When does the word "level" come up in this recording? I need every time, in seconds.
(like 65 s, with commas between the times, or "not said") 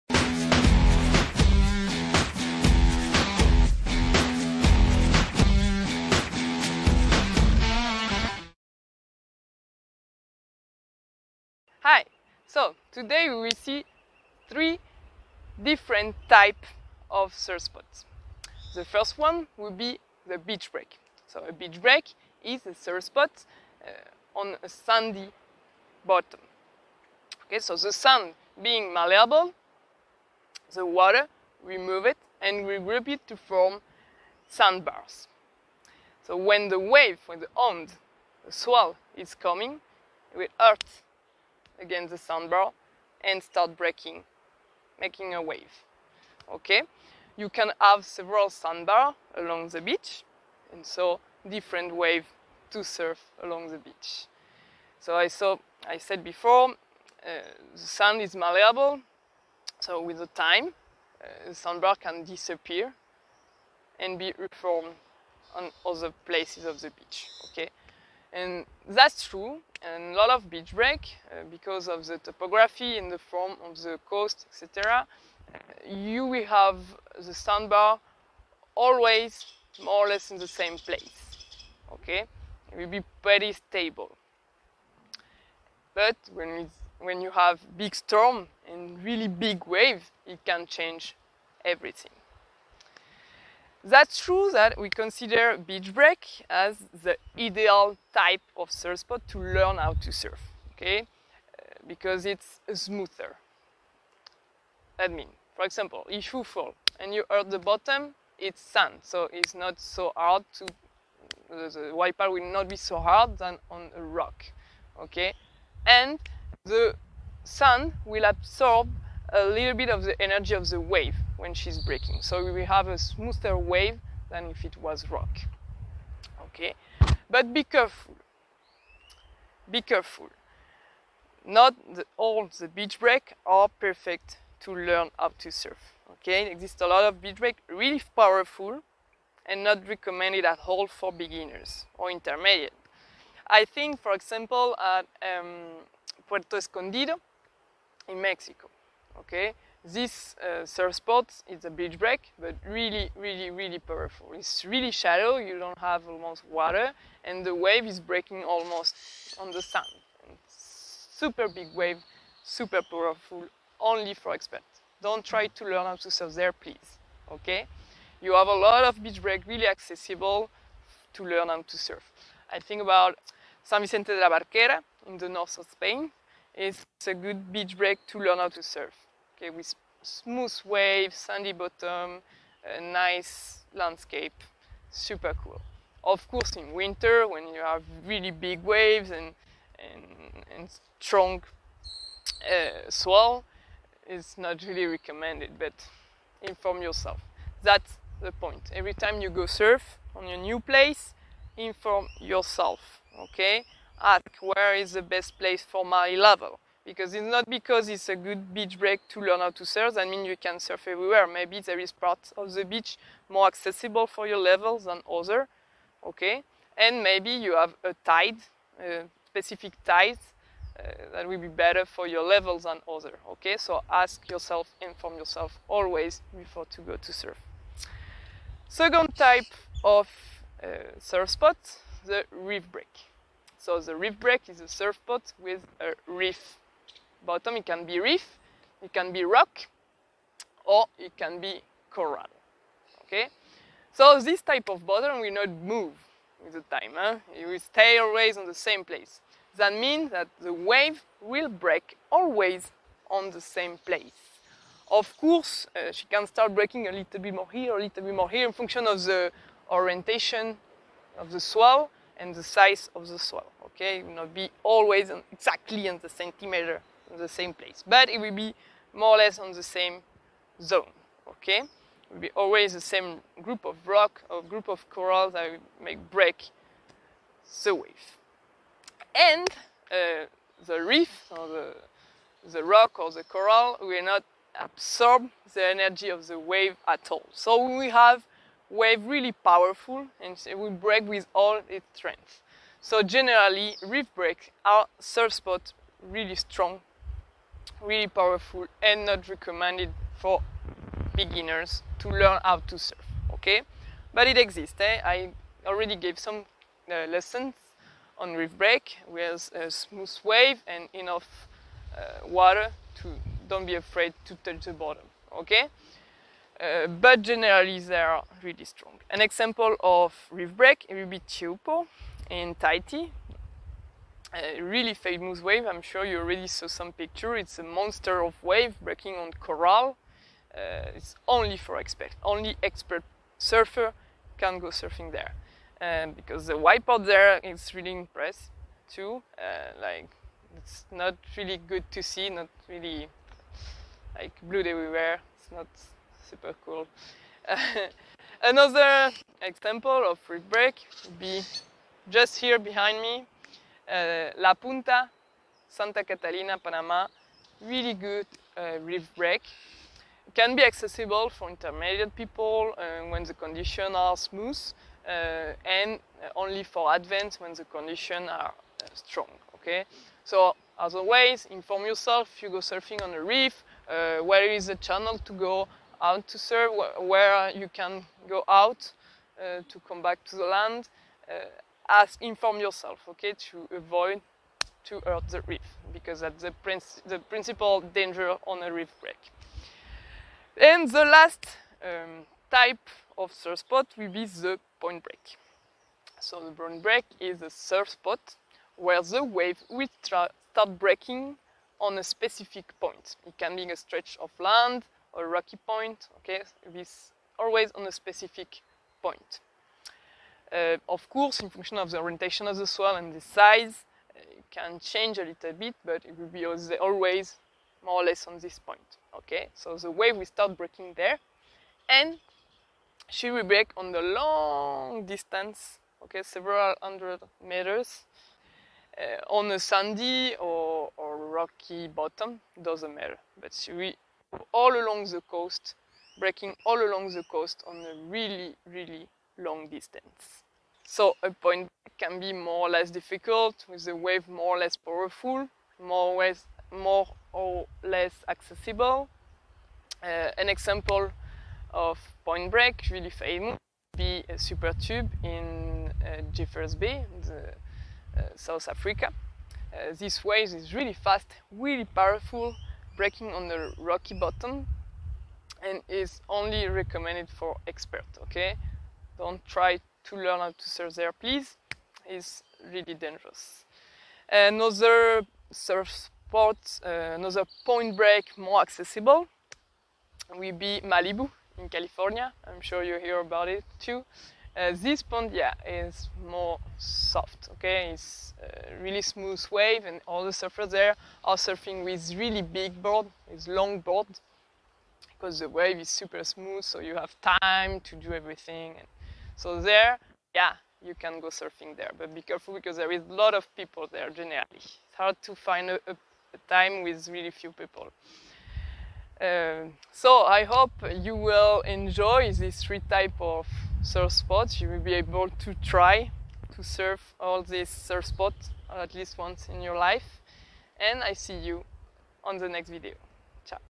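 206 s, 214 s, 222 s.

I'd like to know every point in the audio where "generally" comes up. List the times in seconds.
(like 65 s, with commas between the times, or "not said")
293 s, 317 s, 504 s.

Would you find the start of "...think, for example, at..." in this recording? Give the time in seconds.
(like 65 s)
143 s.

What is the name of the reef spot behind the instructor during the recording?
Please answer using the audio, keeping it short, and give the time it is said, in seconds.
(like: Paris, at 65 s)
La Punta, at 354 s.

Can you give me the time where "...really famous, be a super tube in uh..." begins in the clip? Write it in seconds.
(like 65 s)
452 s.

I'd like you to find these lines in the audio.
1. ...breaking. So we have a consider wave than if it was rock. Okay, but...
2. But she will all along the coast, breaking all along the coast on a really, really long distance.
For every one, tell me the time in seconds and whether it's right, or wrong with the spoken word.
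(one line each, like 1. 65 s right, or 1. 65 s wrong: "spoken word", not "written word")
1. 121 s wrong: "smoother", not "consider"
2. 433 s right.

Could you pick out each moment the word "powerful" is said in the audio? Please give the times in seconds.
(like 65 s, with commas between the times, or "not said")
138 s, 153 s, 162 s, 289 s, 298 s, 444 s, 461 s.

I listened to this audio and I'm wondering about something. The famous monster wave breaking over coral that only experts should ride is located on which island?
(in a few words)
Tahiti.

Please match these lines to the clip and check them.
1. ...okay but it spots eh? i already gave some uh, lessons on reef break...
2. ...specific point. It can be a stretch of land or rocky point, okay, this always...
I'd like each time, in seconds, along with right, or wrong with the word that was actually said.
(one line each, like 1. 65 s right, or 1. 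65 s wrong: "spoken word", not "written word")
1. 303 s wrong: "exists", not "spots"
2. 402 s right.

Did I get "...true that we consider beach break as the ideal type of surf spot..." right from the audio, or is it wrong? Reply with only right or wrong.
right.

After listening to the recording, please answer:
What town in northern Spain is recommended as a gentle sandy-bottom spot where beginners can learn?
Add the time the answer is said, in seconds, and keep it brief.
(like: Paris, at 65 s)
San Vicente de la Barquera, at 173 s.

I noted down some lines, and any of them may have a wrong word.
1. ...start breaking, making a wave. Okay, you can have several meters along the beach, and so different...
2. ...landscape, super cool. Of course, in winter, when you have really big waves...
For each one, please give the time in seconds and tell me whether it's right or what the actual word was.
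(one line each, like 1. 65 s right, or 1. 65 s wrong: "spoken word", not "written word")
1. 43 s wrong: "sandbars", not "meters"
2. 183 s right.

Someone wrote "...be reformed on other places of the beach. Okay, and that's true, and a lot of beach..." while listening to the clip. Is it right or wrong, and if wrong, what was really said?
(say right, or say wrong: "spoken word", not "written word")
right.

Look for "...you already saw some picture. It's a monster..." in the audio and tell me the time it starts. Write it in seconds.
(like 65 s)
326 s.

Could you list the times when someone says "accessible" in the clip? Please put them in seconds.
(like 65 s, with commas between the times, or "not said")
169 s, 213 s, 360 s, 448 s, 478 s.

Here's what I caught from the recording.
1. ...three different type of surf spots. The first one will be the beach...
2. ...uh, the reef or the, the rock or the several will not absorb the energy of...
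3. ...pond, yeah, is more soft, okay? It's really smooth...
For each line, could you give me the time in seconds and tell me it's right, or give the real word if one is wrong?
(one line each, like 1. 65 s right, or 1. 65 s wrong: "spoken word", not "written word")
1. 14 s right
2. 279 s wrong: "coral", not "several"
3. 485 s right.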